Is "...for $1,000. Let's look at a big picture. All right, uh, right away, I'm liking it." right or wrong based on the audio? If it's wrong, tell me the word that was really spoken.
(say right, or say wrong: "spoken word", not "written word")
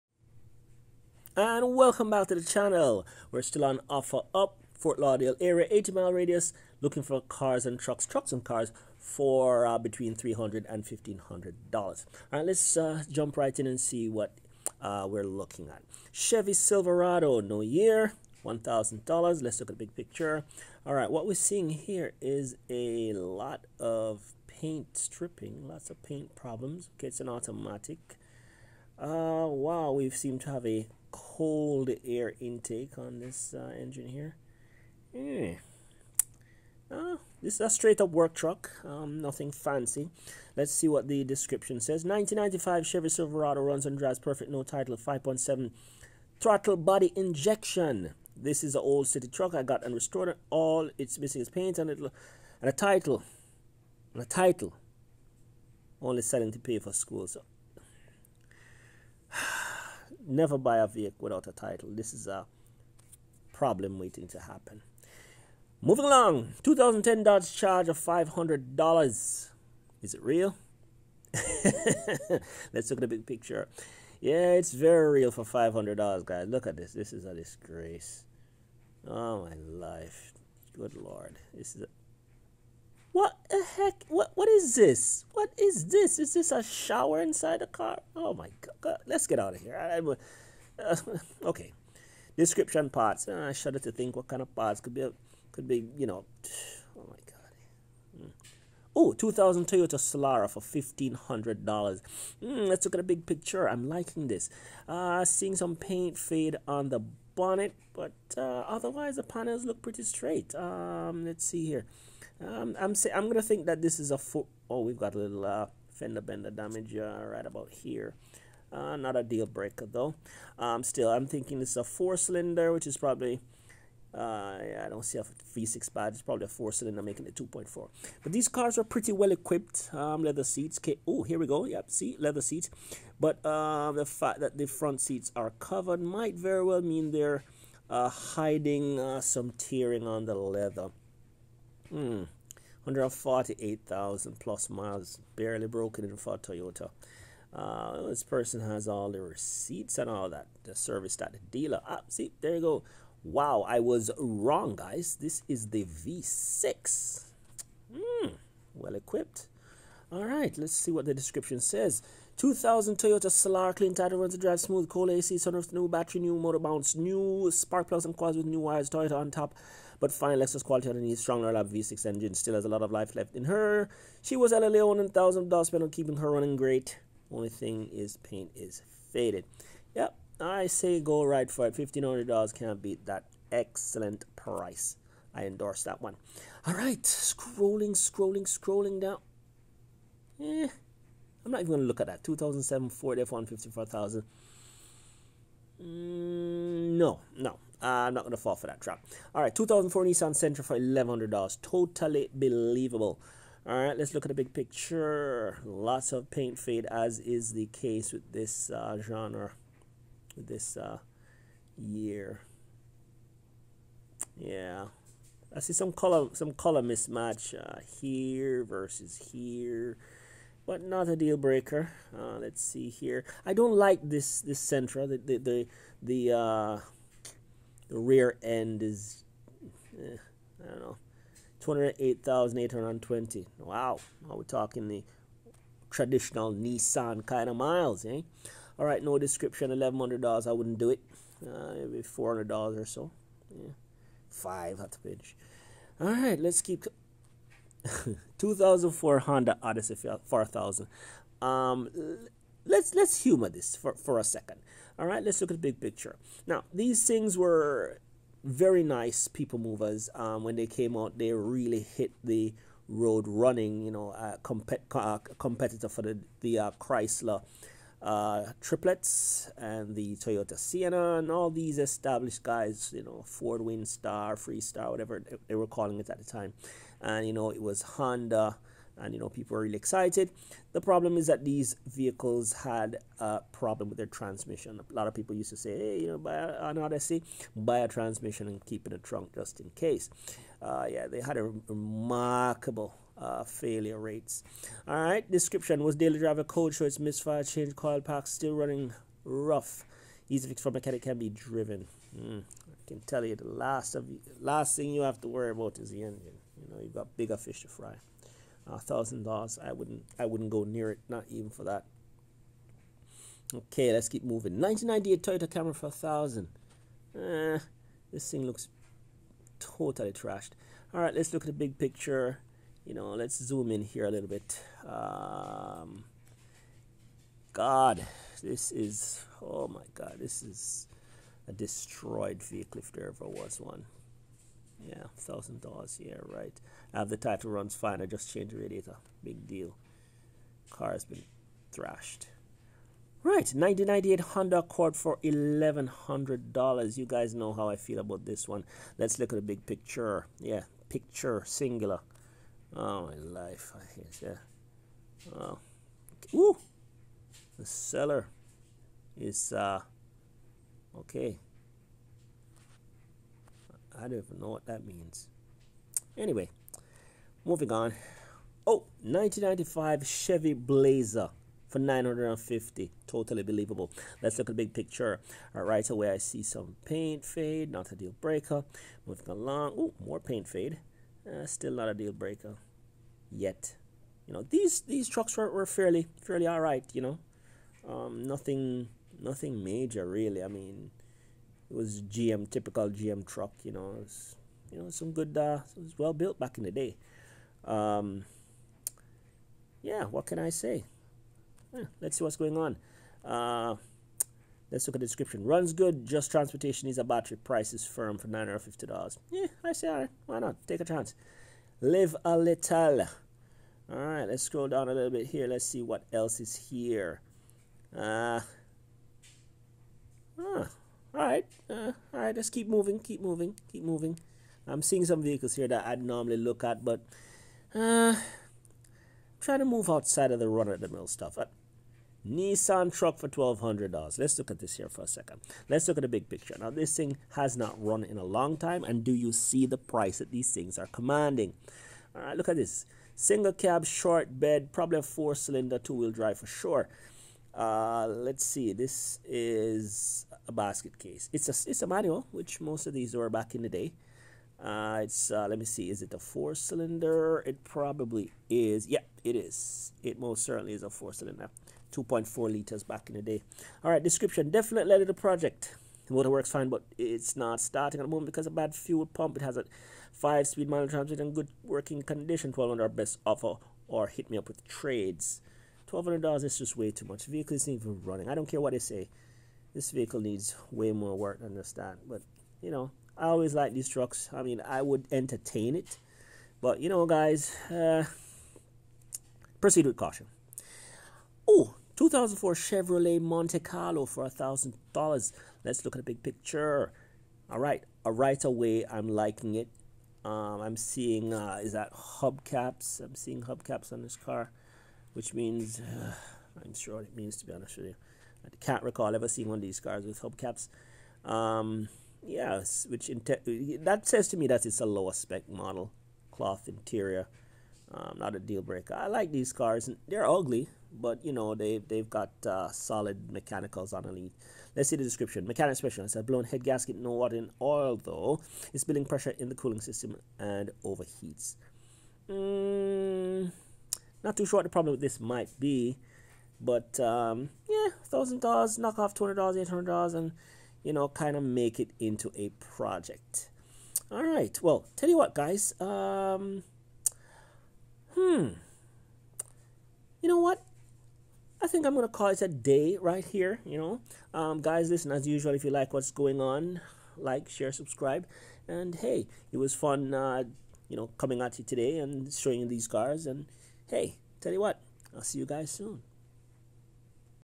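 right.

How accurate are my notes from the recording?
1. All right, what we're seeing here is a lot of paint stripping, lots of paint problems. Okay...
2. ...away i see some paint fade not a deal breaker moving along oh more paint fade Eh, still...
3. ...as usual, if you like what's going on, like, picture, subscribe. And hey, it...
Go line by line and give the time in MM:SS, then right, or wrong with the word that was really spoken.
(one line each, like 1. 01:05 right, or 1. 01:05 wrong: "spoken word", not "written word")
1. 00:20 right
2. 06:15 right
3. 09:15 wrong: "share", not "picture".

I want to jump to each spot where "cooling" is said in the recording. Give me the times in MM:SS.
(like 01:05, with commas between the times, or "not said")
08:49.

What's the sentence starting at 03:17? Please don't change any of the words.
Uh, I'm not going to fall for that trap.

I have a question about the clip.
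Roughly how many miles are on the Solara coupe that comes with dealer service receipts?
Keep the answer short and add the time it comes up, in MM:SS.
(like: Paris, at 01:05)
148,000, at 02:22.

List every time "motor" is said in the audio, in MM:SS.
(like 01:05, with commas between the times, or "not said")
02:46, 07:46.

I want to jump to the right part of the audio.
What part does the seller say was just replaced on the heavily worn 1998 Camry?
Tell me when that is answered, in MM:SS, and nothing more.
05:38.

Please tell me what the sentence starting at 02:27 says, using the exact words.
Uh, this person has all the receipts and all that, the service at the dealer.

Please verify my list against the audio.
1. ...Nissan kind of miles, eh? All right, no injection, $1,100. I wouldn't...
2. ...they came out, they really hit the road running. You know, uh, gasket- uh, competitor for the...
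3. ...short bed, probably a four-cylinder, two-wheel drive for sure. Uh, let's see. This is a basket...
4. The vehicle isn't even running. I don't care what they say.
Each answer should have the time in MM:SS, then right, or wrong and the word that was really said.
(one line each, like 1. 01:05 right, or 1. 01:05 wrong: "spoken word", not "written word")
1. 03:56 wrong: "description", not "injection"
2. 04:20 wrong: "compet", not "gasket"
3. 07:23 right
4. 07:57 right.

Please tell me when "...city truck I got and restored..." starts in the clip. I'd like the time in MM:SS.
00:49.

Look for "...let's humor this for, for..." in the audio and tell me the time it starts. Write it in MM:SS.
04:12.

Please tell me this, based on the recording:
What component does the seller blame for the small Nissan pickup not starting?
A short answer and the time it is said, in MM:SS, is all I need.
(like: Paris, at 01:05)
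fuel pump, at 07:48.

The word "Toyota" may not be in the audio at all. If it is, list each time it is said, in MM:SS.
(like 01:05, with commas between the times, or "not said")
01:39, 02:26, 02:42, 02:48, 04:30, 05:15.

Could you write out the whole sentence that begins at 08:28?
I can't recall ever seeing one of these cars with hubcaps.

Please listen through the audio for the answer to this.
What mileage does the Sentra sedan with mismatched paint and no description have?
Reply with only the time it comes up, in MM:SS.
03:51.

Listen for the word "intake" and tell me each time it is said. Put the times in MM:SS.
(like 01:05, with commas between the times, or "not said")
00:32.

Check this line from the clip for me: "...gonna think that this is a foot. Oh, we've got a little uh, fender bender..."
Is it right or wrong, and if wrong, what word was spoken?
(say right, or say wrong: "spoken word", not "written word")
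right.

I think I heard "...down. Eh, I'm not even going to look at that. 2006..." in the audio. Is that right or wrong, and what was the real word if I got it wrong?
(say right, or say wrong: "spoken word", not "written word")
wrong: "2007", not "2006".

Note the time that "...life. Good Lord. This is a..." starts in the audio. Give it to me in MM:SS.
01:19.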